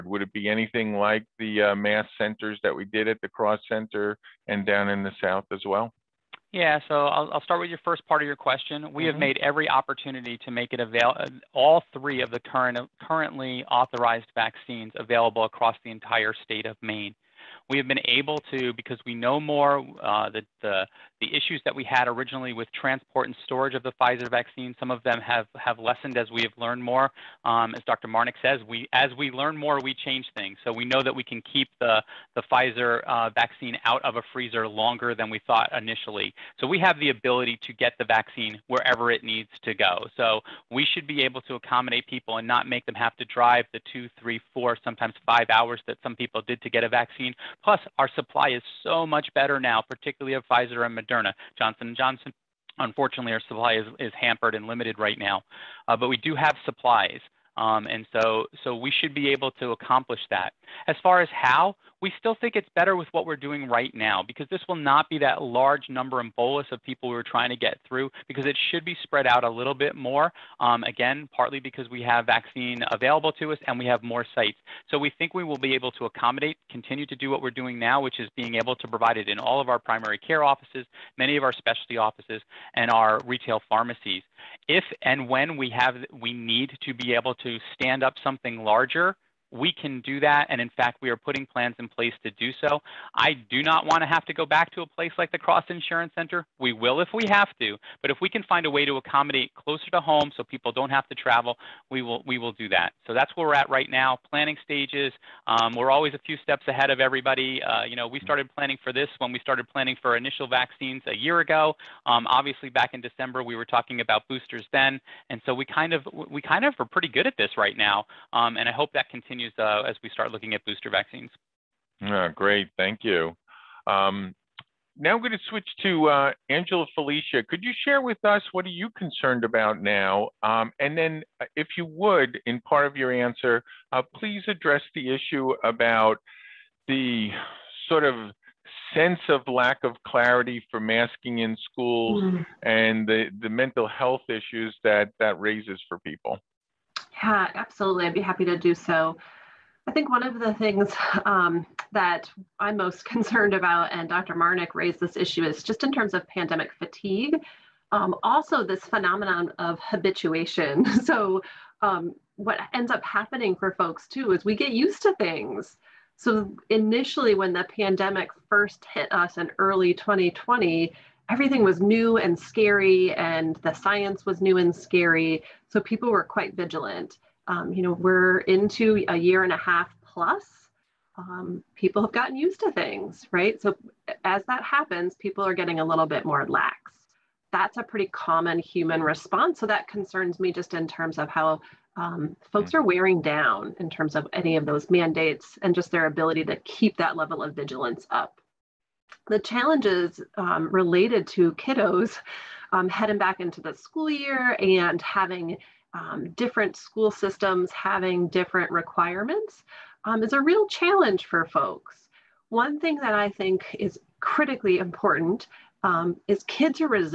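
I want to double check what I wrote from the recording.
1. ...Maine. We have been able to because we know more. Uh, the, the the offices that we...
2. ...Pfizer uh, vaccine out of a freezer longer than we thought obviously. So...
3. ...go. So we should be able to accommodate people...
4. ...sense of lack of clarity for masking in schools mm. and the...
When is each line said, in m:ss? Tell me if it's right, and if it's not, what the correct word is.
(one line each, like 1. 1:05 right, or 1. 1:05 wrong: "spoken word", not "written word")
1. 0:16 wrong: "issues", not "offices"
2. 0:32 wrong: "initially", not "obviously"
3. 0:39 right
4. 2:18 right.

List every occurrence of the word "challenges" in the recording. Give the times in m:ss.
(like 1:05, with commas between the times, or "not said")
3:19, 3:30.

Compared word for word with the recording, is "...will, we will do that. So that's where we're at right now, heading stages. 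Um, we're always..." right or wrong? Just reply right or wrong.
wrong.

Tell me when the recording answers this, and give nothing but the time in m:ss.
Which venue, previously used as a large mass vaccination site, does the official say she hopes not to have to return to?
1:35.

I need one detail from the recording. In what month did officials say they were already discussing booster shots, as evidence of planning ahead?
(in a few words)
December.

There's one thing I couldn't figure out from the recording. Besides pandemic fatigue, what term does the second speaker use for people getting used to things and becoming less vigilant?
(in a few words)
habituation.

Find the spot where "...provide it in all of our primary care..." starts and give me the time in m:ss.
1:18.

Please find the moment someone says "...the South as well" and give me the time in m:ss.
0:05.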